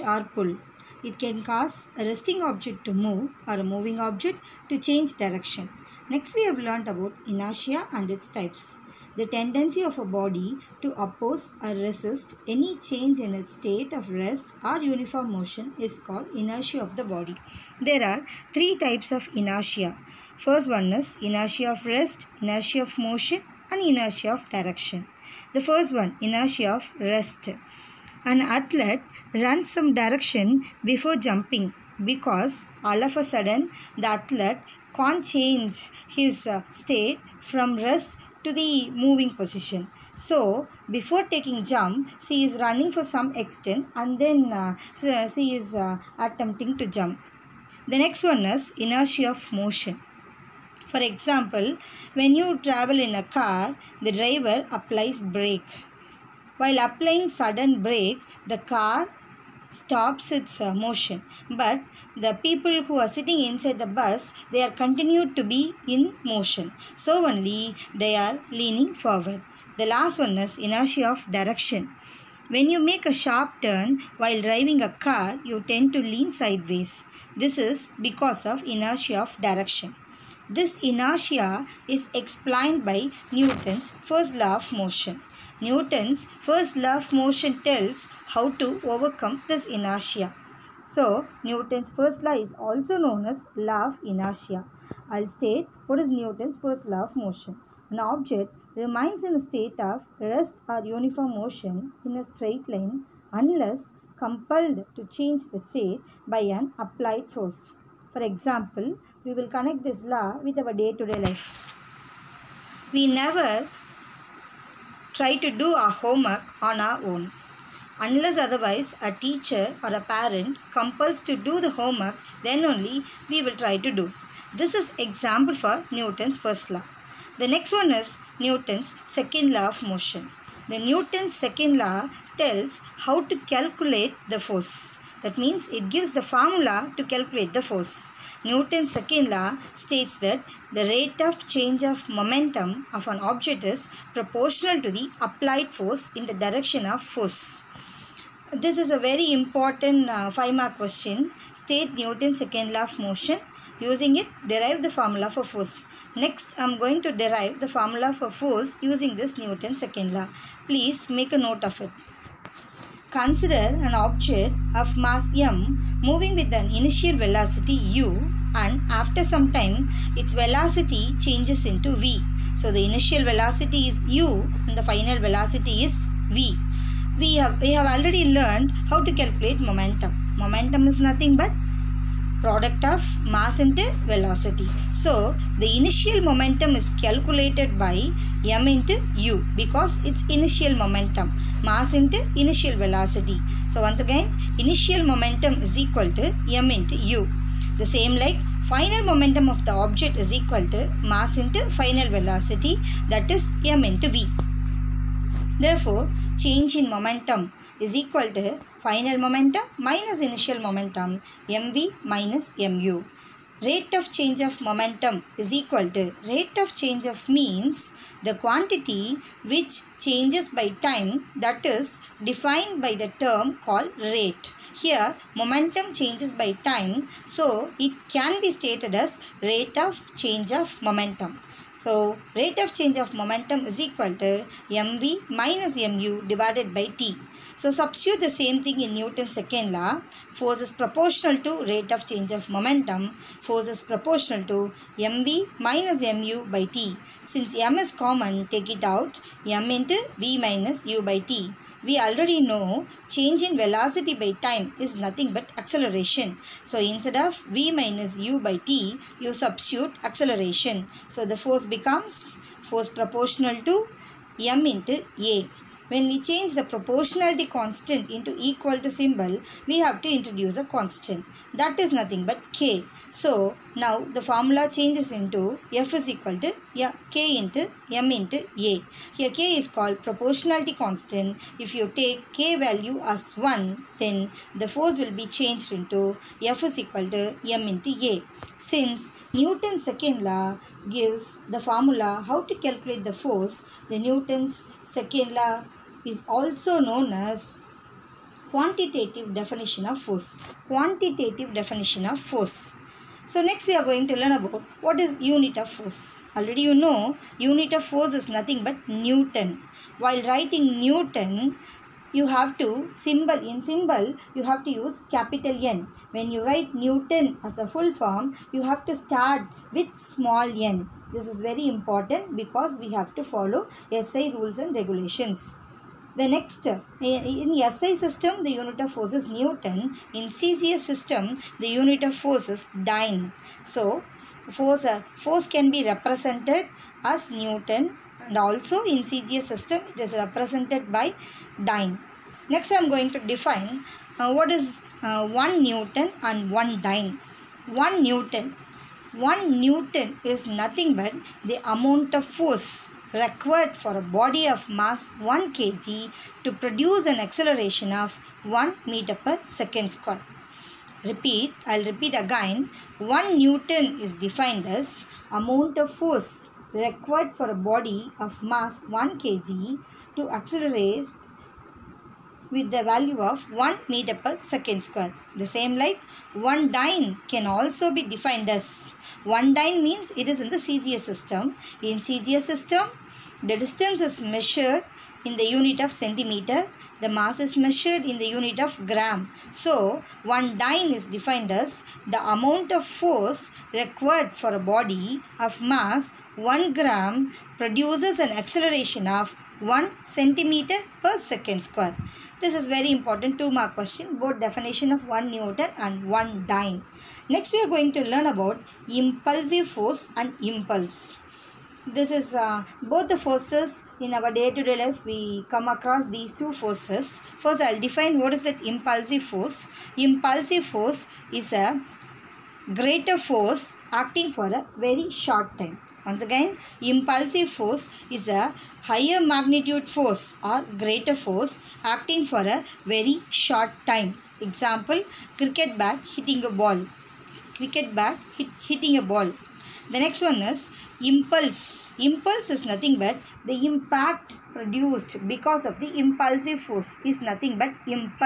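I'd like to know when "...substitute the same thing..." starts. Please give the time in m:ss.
3:57.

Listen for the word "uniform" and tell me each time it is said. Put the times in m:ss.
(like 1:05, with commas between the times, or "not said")
0:14, 1:40.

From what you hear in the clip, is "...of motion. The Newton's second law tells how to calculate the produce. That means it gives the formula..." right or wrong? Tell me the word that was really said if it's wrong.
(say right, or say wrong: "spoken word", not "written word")
wrong: "force", not "produce".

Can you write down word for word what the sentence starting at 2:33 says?
Using it, derive the formula for force.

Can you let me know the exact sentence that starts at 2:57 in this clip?
We have, we have already learned how to calculate momentum.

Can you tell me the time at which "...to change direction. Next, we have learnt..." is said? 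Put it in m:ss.
0:04.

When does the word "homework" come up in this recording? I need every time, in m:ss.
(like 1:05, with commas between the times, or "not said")
1:56, 2:01.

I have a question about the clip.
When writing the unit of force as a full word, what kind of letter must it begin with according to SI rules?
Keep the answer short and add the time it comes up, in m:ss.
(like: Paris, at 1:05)
Small n, at 5:19.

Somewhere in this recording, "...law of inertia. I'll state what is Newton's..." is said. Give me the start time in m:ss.
1:33.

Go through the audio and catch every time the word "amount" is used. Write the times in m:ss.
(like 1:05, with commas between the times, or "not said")
5:51, 6:05, 6:32.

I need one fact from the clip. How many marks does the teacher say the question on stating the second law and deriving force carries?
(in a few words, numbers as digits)
5.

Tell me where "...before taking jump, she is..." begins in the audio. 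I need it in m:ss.
0:40.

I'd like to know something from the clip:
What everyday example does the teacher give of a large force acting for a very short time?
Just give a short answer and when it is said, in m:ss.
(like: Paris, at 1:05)
Cricket bat hitting a ball, at 7:15.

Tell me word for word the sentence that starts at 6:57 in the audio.
First I will define what is that impulsive force.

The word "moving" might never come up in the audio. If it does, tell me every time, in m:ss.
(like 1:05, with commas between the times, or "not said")
0:03, 0:39, 2:46.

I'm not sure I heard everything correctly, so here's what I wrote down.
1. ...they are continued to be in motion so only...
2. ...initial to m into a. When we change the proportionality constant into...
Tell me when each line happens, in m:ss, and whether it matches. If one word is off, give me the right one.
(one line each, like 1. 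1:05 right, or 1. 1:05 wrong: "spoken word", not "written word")
1. 1:04 right
2. 4:22 wrong: "proportional", not "initial".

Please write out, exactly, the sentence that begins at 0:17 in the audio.
There are three types of inertia.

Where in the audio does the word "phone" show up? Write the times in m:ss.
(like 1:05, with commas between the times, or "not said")
not said.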